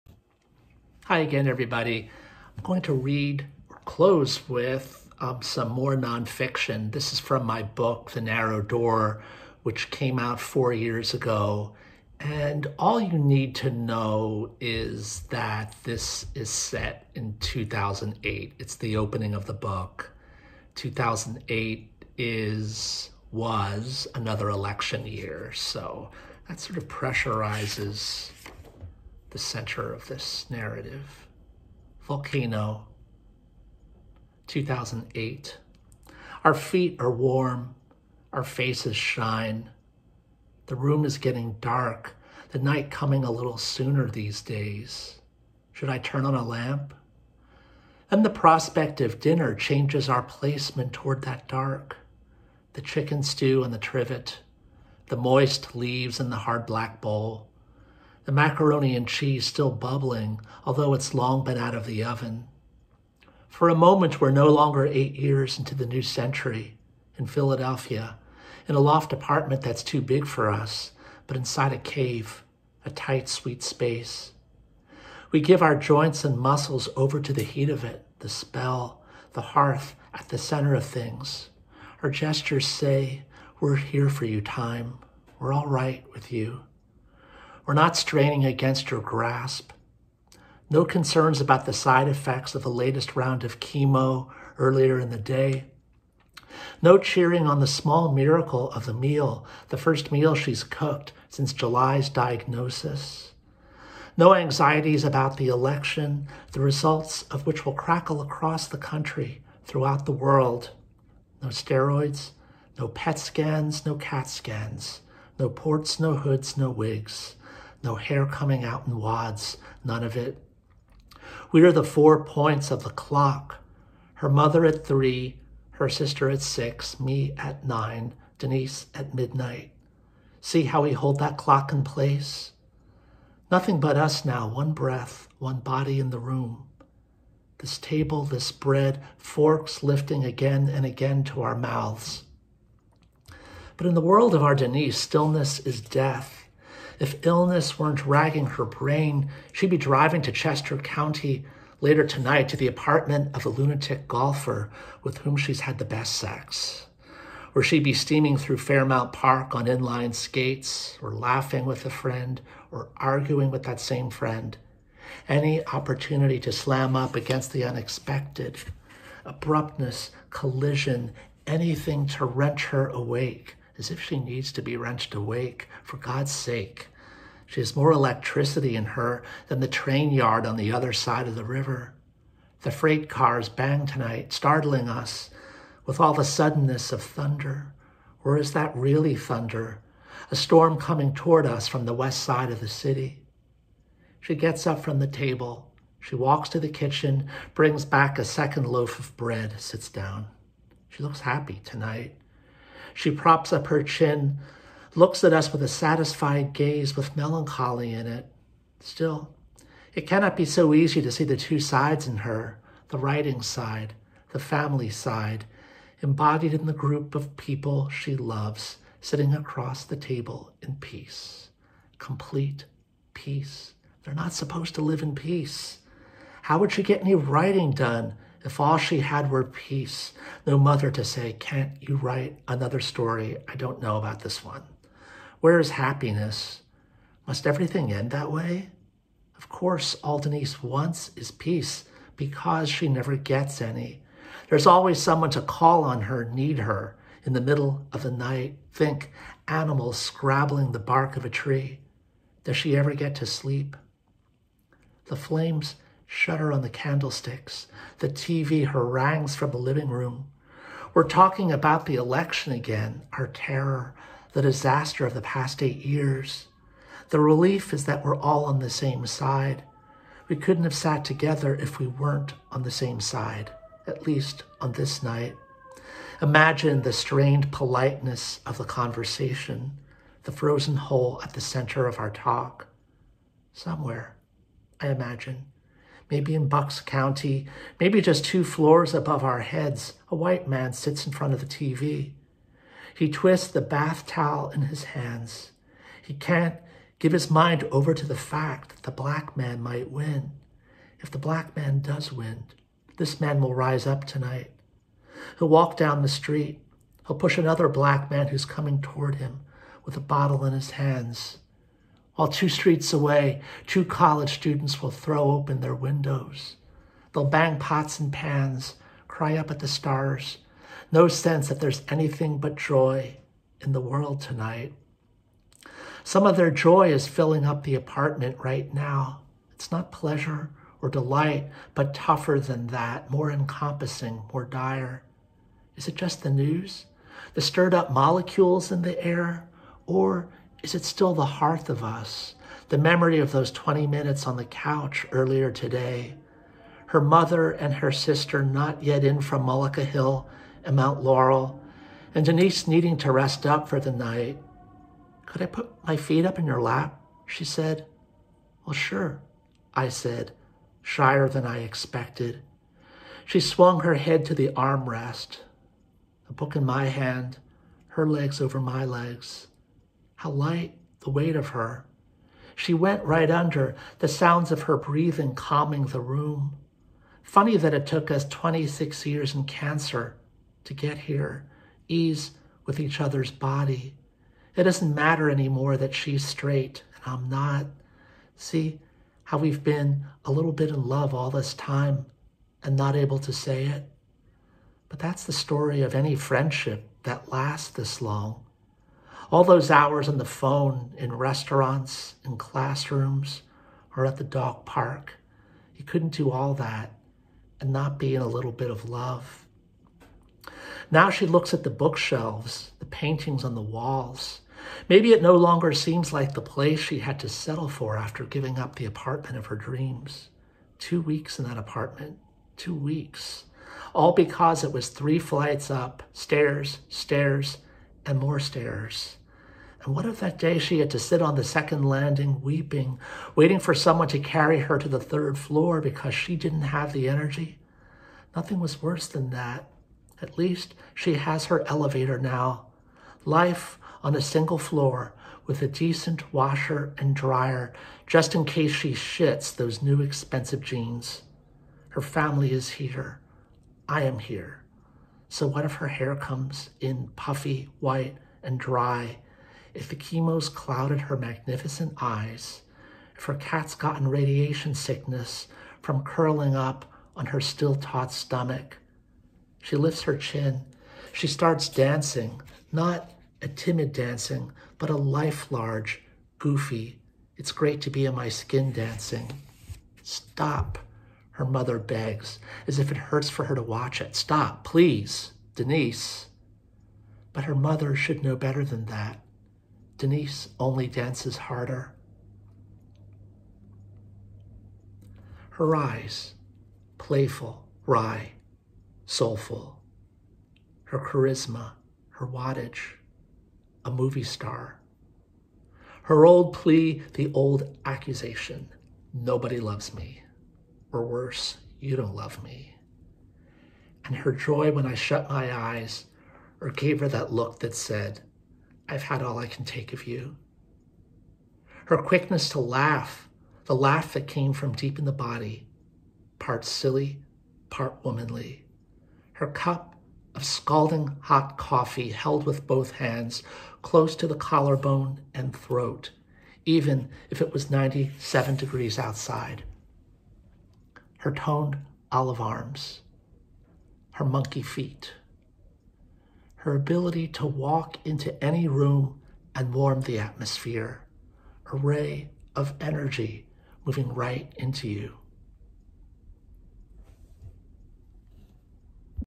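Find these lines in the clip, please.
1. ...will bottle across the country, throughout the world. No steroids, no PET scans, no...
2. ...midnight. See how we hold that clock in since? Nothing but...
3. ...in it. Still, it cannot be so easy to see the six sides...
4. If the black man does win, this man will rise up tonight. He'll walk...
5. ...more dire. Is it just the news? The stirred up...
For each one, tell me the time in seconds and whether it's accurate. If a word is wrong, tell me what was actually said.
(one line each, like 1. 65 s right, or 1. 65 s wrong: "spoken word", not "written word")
1. 107 s wrong: "crackle", not "bottle"
2. 129 s wrong: "place", not "since"
3. 207 s wrong: "two", not "six"
4. 300 s right
5. 334 s right.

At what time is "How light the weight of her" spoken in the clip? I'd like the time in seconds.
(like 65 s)
370 s.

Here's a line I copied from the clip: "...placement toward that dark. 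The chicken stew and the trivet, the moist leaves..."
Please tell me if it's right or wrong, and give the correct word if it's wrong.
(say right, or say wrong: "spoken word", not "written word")
right.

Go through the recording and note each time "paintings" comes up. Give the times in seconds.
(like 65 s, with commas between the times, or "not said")
412 s.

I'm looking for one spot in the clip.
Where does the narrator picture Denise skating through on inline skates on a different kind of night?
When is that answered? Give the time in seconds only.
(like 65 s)
158 s.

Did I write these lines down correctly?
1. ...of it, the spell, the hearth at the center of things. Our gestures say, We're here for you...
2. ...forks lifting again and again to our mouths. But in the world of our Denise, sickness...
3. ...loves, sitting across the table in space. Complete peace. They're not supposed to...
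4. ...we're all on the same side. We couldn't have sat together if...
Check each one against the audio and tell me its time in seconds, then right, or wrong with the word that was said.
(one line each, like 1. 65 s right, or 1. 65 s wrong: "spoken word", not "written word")
1. 77 s right
2. 139 s wrong: "stillness", not "sickness"
3. 218 s wrong: "peace", not "space"
4. 268 s right.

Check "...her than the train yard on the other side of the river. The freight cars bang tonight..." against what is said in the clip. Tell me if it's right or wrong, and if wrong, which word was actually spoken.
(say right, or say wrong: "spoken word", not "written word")
right.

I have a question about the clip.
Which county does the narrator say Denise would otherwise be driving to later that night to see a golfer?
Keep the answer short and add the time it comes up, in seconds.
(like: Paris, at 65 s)
Chester County, at 150 s.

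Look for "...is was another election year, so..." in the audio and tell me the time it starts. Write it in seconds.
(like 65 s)
22 s.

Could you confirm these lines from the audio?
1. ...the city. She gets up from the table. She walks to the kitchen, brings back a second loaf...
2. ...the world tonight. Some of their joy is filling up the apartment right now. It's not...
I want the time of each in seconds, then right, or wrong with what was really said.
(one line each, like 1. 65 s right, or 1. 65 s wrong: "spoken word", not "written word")
1. 192 s right
2. 323 s right.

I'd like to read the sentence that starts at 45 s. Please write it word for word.
Should I turn on a lamp?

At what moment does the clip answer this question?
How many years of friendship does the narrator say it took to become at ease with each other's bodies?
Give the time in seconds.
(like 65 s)
378 s.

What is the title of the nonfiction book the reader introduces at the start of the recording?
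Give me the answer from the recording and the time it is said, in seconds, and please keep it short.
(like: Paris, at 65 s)
The Narrow Door, at 8 s.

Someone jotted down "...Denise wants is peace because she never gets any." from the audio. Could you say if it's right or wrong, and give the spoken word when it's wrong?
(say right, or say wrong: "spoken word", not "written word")
right.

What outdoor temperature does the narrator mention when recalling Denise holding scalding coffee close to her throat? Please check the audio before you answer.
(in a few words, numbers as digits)
97 degrees.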